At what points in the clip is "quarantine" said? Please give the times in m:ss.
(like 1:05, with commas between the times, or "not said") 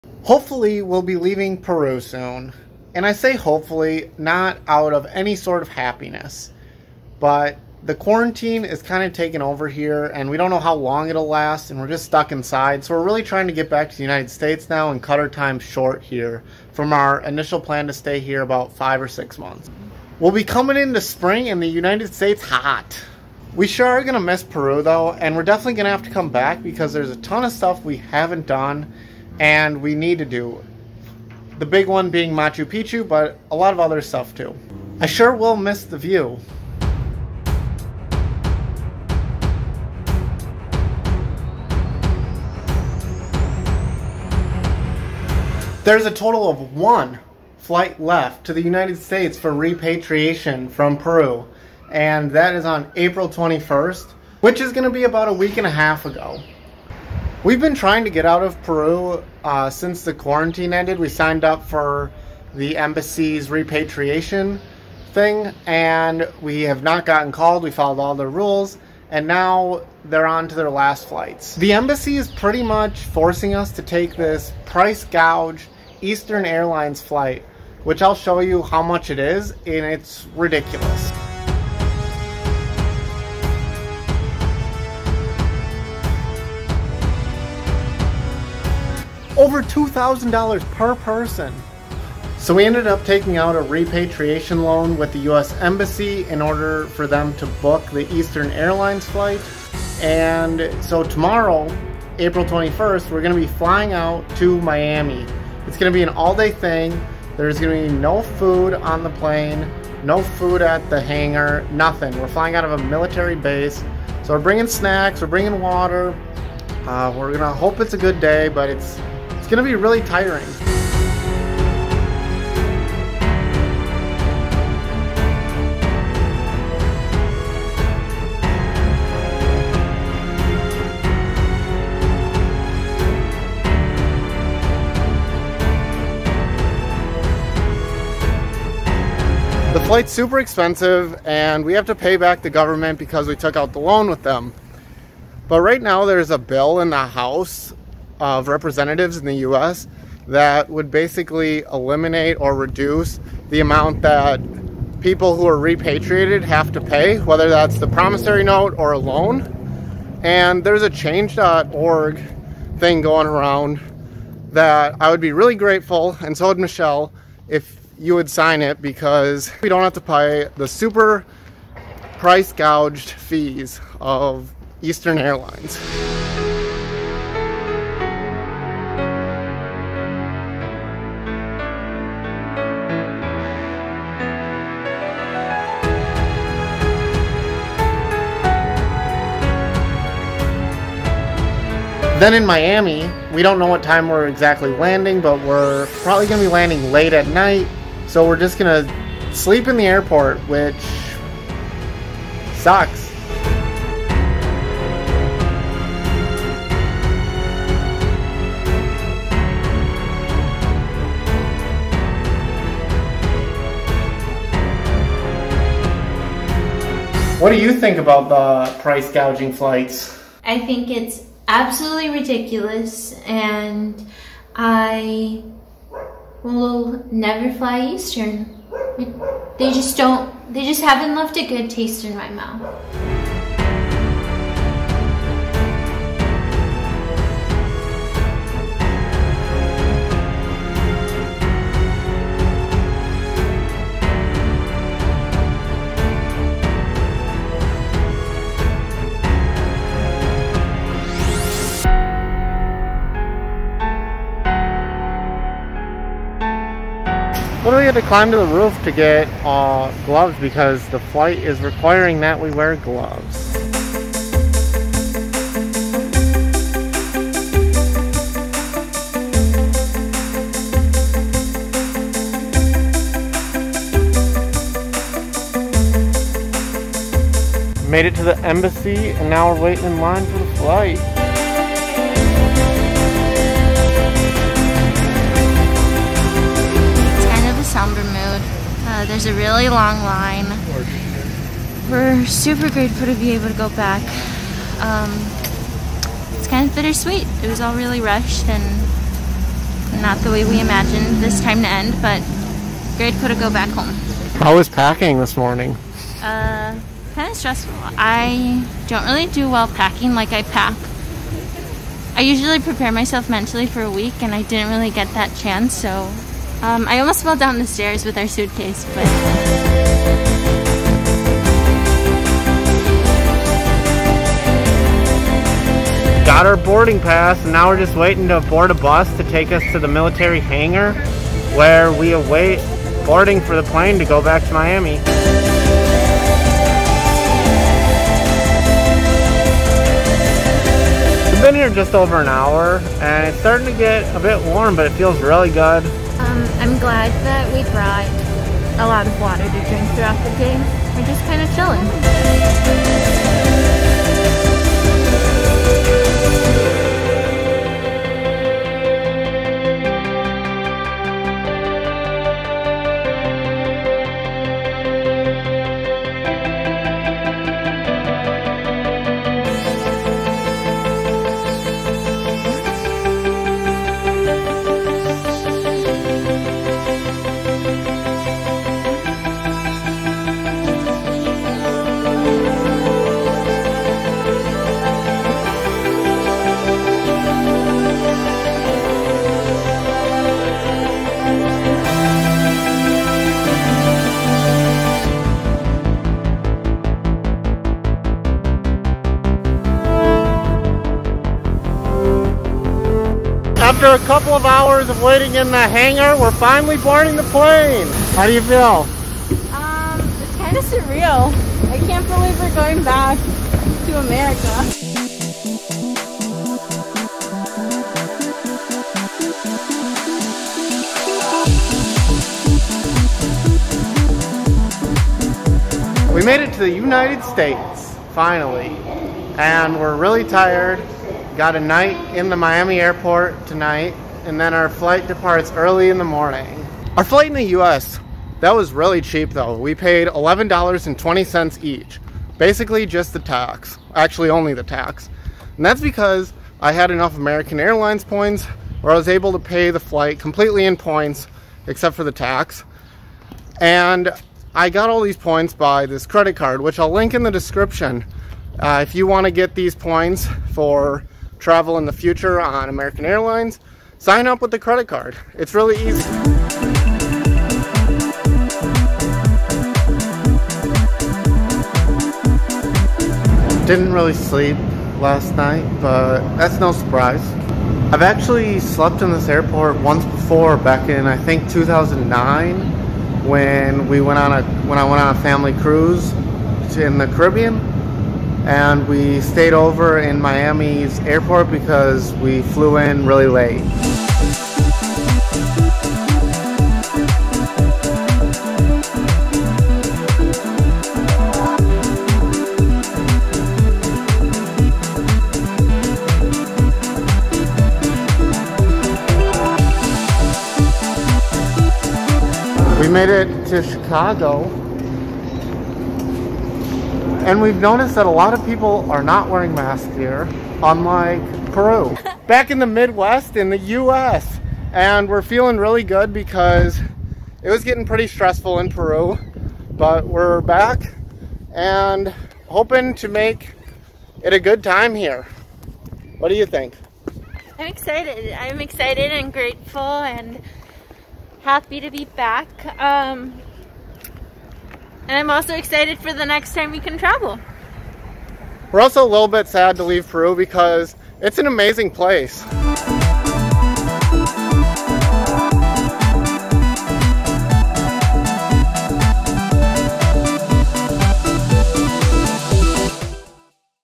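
0:07, 1:00.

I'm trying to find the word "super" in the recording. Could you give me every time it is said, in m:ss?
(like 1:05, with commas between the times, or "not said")
2:20, 2:50, 4:52.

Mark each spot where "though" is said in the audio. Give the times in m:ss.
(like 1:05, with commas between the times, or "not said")
0:24, 7:19.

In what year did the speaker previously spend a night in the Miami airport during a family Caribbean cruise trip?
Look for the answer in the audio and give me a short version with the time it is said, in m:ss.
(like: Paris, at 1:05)
2009, at 8:01.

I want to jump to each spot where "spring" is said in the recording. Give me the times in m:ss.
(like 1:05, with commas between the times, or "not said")
0:21.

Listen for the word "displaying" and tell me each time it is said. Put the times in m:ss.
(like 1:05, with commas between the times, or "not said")
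not said.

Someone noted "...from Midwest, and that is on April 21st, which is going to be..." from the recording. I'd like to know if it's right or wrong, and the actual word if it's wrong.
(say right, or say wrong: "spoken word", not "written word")
wrong: "Peru", not "Midwest".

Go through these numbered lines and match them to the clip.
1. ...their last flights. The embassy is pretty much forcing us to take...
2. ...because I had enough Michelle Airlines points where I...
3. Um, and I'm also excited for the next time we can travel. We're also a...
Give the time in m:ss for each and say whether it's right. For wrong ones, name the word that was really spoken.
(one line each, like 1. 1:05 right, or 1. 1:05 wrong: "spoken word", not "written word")
1. 1:10 right
2. 7:25 wrong: "American", not "Michelle"
3. 9:02 right.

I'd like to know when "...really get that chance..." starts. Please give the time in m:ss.
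5:14.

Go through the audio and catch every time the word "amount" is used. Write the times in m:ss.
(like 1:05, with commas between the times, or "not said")
2:33.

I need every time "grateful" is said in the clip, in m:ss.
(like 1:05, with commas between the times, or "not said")
2:45, 4:52, 5:02, 8:59.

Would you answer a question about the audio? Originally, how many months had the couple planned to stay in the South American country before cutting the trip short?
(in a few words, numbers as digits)
5 or 6 months.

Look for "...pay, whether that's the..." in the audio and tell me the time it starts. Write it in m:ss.
2:36.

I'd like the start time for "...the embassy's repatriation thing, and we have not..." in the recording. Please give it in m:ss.
1:02.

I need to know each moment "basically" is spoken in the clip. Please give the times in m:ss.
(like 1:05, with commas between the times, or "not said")
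2:30, 7:22.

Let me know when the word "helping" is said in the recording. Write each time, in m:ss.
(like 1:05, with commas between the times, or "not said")
not said.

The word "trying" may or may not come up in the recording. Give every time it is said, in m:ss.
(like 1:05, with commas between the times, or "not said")
0:13, 0:57.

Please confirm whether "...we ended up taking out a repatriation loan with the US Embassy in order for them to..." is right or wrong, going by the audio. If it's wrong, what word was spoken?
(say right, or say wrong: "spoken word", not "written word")
right.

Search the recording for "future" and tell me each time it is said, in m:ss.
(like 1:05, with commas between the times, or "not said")
7:41.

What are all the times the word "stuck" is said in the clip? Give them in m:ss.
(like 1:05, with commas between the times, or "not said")
0:12.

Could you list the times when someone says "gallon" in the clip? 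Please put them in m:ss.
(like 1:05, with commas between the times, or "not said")
not said.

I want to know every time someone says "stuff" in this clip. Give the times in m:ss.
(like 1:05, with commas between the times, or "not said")
0:27, 0:34.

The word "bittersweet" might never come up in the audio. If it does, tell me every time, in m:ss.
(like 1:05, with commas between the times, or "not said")
4:56.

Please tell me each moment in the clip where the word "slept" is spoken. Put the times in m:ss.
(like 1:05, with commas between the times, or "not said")
7:58.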